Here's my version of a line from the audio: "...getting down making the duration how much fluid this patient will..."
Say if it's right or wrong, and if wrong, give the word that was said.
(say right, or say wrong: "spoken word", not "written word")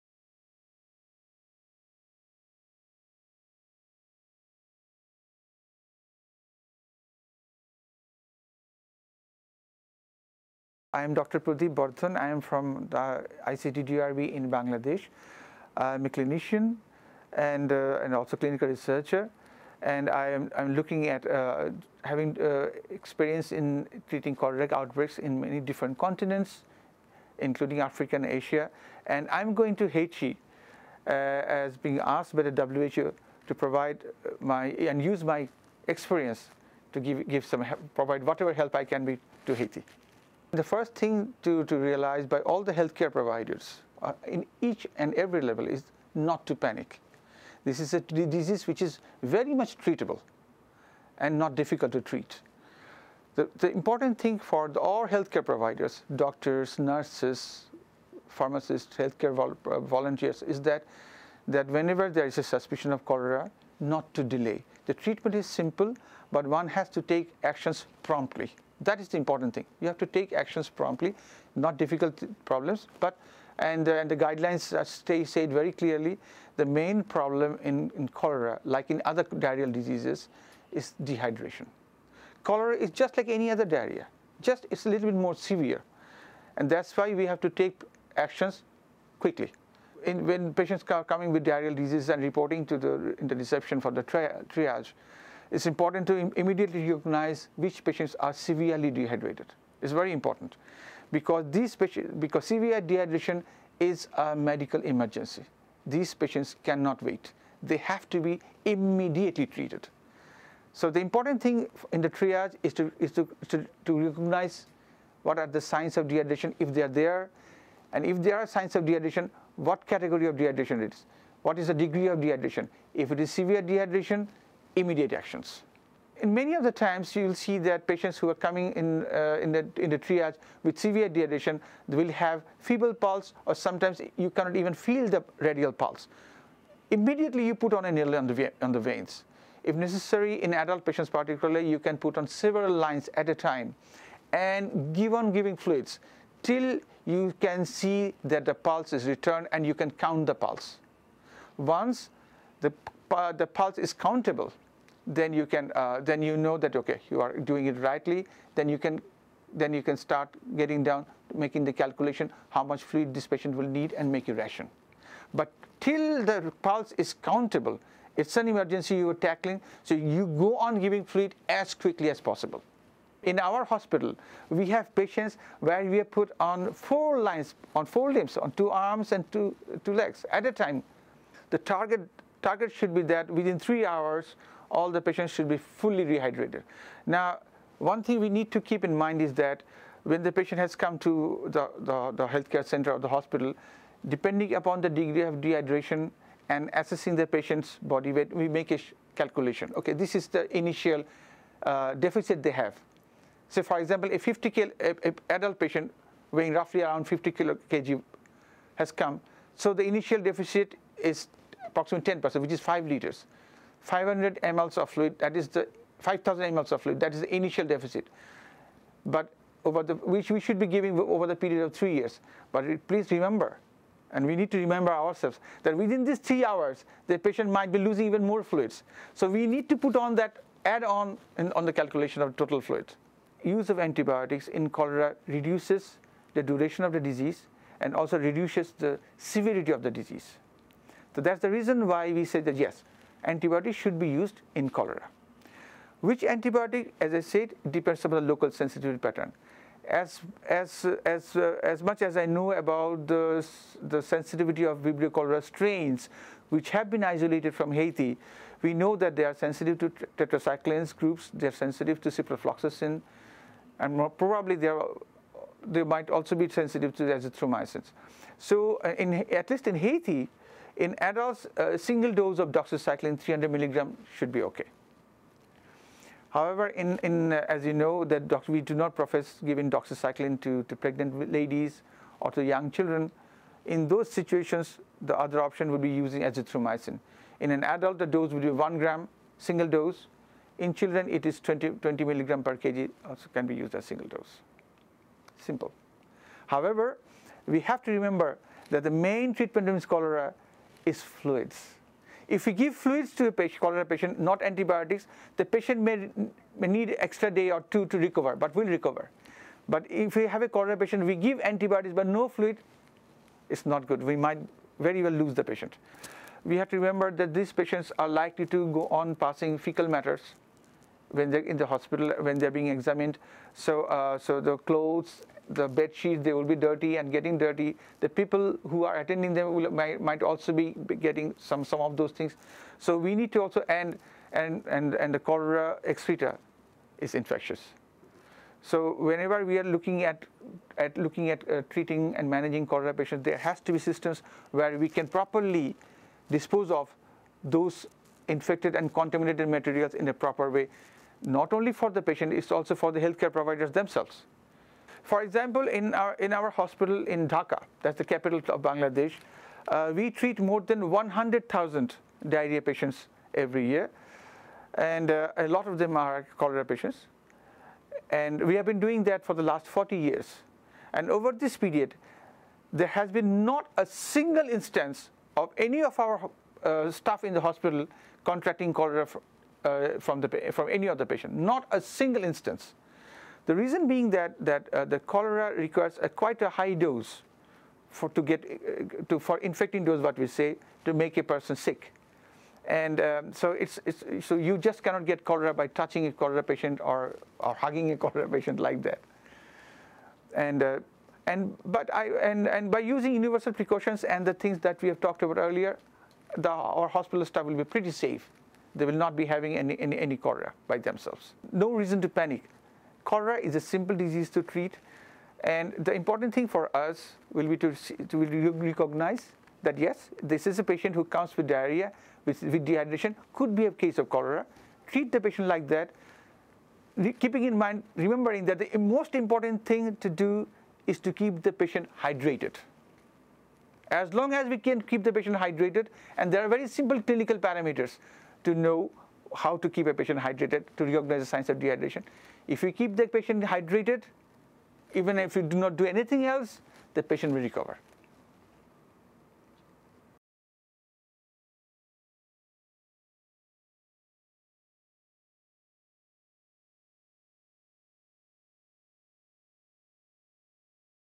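wrong: "calculation", not "duration".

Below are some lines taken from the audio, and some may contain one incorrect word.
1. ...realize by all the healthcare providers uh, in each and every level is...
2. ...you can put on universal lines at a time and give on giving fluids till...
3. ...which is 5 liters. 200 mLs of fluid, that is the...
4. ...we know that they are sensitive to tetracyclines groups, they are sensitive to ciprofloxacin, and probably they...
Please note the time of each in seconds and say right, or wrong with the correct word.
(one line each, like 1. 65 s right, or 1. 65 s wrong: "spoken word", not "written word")
1. 41 s right
2. 141 s wrong: "several", not "universal"
3. 212 s wrong: "500", not "200"
4. 258 s right.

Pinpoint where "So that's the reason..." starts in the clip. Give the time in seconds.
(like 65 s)
241 s.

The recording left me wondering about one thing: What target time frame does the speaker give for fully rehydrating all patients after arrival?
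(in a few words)
3 hours.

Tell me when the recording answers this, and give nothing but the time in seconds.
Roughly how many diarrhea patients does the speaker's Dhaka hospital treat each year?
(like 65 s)
360 s.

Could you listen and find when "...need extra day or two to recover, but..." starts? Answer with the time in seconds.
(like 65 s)
306 s.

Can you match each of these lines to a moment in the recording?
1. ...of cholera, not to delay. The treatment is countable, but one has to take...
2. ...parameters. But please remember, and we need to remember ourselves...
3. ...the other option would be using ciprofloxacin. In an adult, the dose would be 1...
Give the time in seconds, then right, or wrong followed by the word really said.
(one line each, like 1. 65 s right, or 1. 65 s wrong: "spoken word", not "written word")
1. 62 s wrong: "simple", not "countable"
2. 221 s wrong: "years", not "parameters"
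3. 285 s wrong: "azithromycin", not "ciprofloxacin".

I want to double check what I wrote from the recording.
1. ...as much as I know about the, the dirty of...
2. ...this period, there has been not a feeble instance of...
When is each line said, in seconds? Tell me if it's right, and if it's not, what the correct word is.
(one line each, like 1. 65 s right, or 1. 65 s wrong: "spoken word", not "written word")
1. 251 s wrong: "sensitivity", not "dirty"
2. 371 s wrong: "single", not "feeble".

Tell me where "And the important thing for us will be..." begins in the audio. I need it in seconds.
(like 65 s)
415 s.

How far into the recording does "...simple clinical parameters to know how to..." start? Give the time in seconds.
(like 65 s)
436 s.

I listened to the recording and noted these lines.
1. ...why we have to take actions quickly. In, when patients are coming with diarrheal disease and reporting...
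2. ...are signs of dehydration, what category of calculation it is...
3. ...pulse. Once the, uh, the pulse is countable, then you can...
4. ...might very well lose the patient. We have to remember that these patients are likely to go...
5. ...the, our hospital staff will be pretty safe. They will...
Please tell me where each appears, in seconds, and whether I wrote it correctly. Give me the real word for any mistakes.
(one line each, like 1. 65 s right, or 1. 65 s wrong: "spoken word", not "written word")
1. 86 s right
2. 118 s wrong: "dehydration", not "calculation"
3. 150 s right
4. 314 s right
5. 406 s right.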